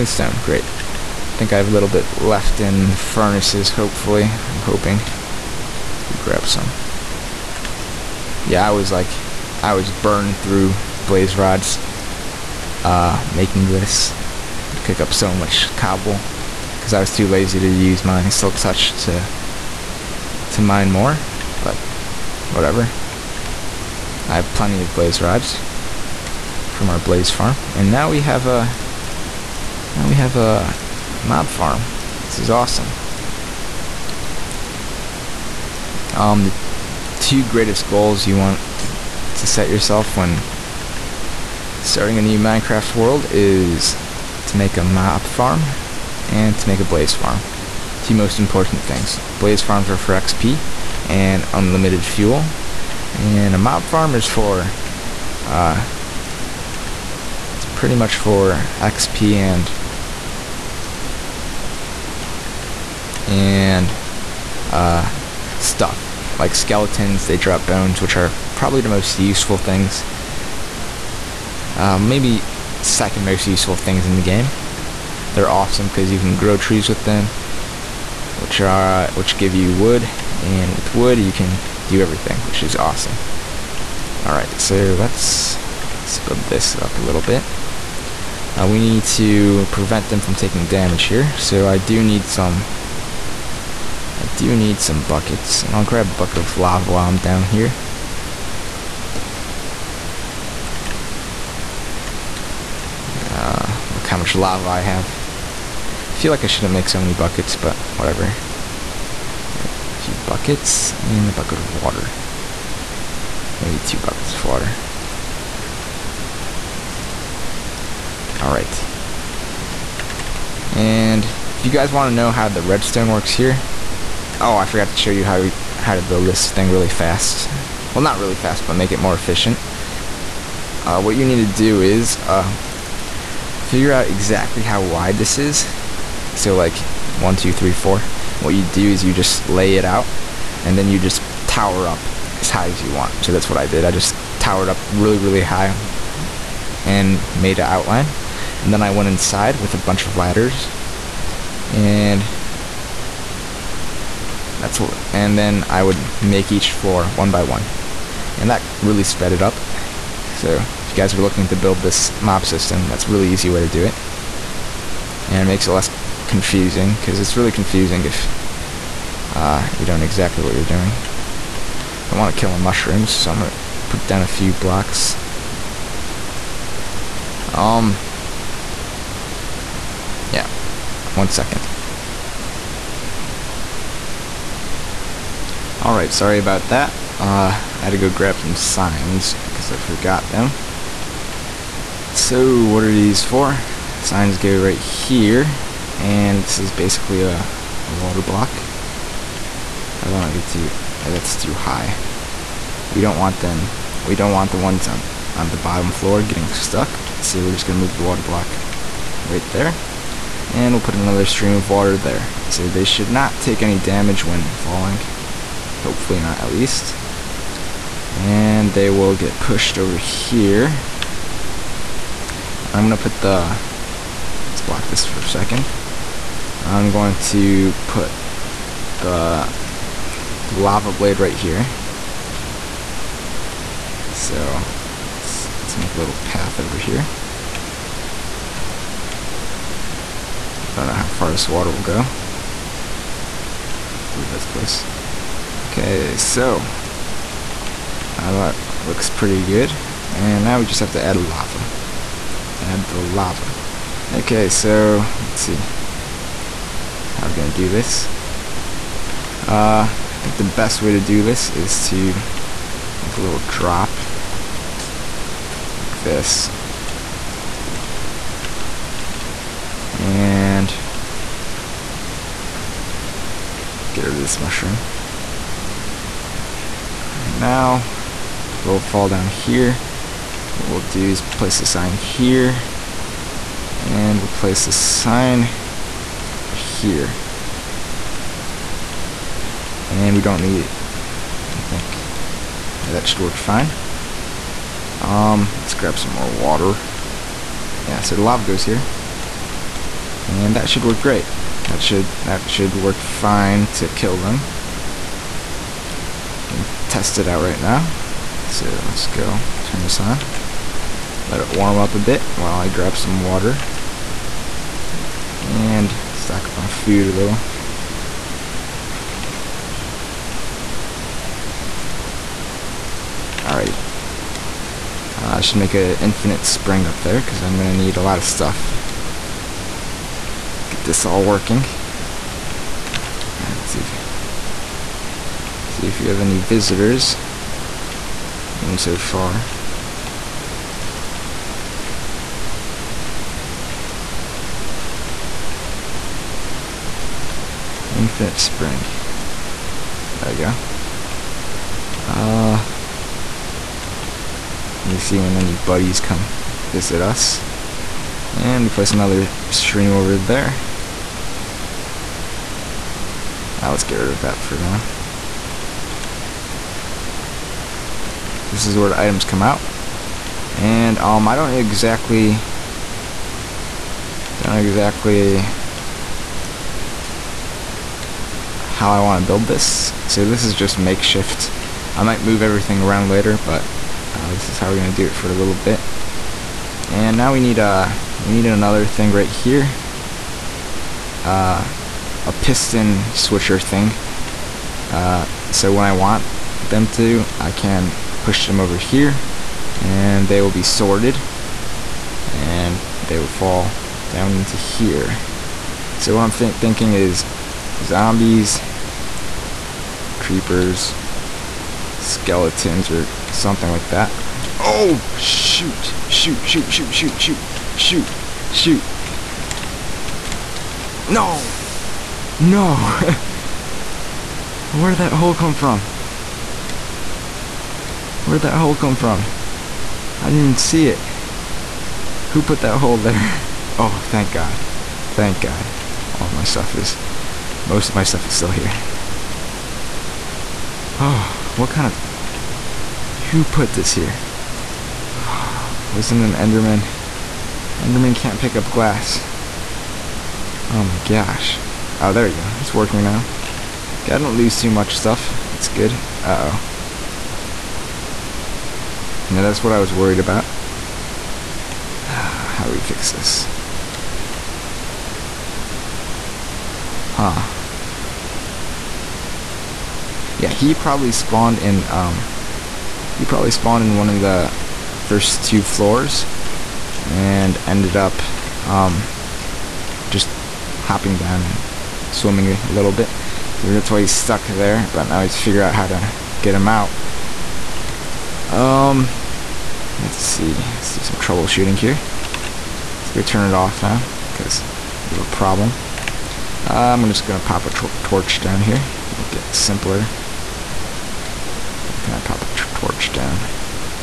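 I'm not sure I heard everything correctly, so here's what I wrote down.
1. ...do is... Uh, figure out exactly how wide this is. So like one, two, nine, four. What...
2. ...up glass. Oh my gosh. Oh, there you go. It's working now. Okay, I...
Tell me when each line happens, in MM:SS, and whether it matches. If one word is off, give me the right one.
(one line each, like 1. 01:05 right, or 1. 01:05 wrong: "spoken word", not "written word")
1. 02:11 wrong: "three", not "nine"
2. 07:28 right.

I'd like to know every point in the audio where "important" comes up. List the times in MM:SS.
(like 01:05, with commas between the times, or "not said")
00:48.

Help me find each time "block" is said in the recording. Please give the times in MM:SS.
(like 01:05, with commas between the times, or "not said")
02:54, 03:18, 03:28, 03:44.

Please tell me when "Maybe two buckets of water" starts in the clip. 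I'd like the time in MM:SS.
01:53.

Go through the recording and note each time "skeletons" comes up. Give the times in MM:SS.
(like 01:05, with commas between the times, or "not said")
01:06, 06:51.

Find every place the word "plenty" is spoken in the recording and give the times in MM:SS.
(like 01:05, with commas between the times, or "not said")
00:24.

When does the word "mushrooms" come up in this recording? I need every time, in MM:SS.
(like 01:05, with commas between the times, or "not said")
02:52, 04:34.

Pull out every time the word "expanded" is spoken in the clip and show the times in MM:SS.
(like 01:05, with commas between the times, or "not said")
not said.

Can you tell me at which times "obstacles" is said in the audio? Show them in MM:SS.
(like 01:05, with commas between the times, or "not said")
not said.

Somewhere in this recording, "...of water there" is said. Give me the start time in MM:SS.
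03:31.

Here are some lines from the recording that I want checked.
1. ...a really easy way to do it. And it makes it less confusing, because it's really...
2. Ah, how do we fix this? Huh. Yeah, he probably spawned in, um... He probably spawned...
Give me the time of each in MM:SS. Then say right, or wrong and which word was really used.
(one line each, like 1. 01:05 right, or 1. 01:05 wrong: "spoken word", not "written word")
1. 02:43 right
2. 07:42 right.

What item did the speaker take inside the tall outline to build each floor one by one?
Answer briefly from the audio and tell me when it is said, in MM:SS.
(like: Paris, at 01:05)
ladders, at 02:30.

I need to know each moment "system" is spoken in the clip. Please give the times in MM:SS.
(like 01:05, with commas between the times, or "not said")
02:42.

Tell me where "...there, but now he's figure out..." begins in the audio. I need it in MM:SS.
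08:04.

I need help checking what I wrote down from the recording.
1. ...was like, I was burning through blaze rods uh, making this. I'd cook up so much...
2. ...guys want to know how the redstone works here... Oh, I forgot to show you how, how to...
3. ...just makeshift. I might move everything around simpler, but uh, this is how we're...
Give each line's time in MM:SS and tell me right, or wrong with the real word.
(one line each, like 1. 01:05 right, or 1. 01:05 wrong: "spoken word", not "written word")
1. 00:08 right
2. 02:01 right
3. 06:20 wrong: "later", not "simpler".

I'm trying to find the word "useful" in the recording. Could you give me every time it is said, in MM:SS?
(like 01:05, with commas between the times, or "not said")
01:09, 01:13.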